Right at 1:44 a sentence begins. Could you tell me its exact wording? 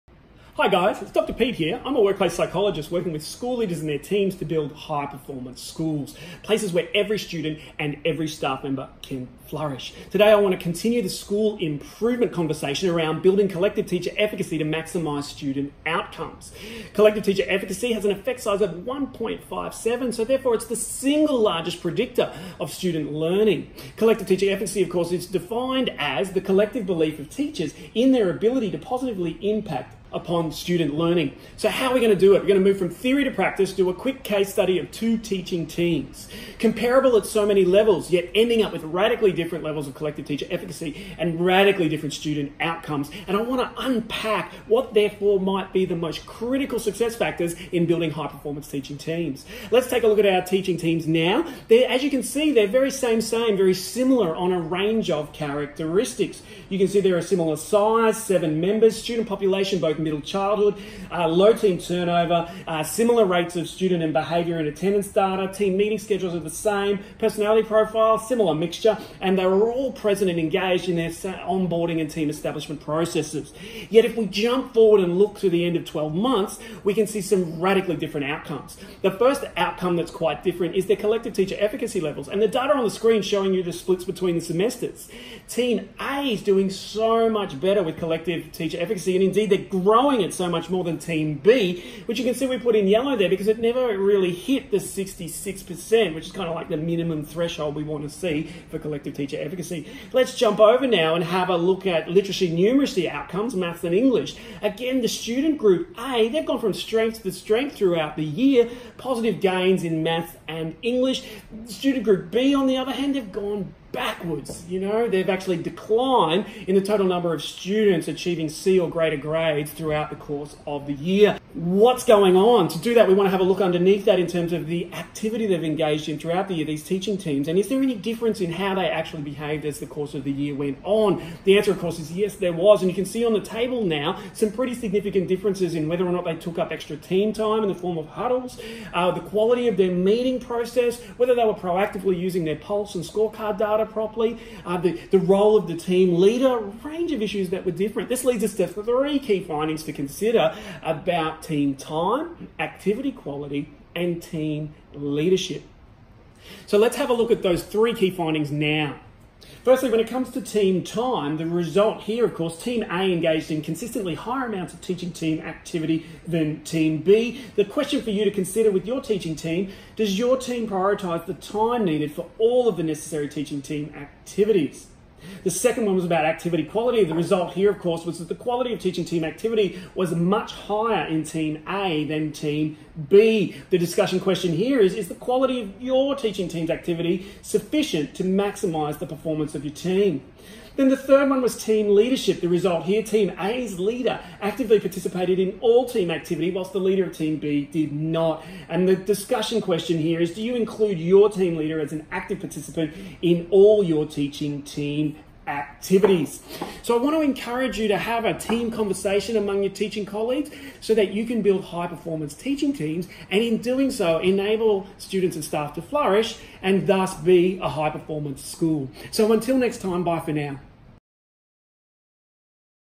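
Again, the student group A, they've gone from strength to strength throughout the year, positive gains in maths and English.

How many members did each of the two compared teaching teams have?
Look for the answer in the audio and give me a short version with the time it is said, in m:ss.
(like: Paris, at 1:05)
7, at 0:58.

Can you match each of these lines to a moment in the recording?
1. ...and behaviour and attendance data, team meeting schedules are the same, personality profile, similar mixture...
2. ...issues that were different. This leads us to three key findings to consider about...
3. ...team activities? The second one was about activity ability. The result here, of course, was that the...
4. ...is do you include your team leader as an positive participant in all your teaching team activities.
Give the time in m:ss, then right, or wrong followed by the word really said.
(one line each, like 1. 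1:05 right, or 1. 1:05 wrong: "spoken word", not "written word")
1. 1:04 right
2. 2:27 right
3. 2:53 wrong: "quality", not "ability"
4. 3:20 wrong: "active", not "positive".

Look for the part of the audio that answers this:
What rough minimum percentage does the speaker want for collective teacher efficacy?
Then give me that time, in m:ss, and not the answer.
1:34.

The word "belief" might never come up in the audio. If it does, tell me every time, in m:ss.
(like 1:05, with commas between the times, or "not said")
0:26.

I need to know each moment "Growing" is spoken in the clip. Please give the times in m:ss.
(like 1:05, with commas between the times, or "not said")
1:29.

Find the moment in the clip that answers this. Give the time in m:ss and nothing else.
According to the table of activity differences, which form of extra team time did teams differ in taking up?
2:18.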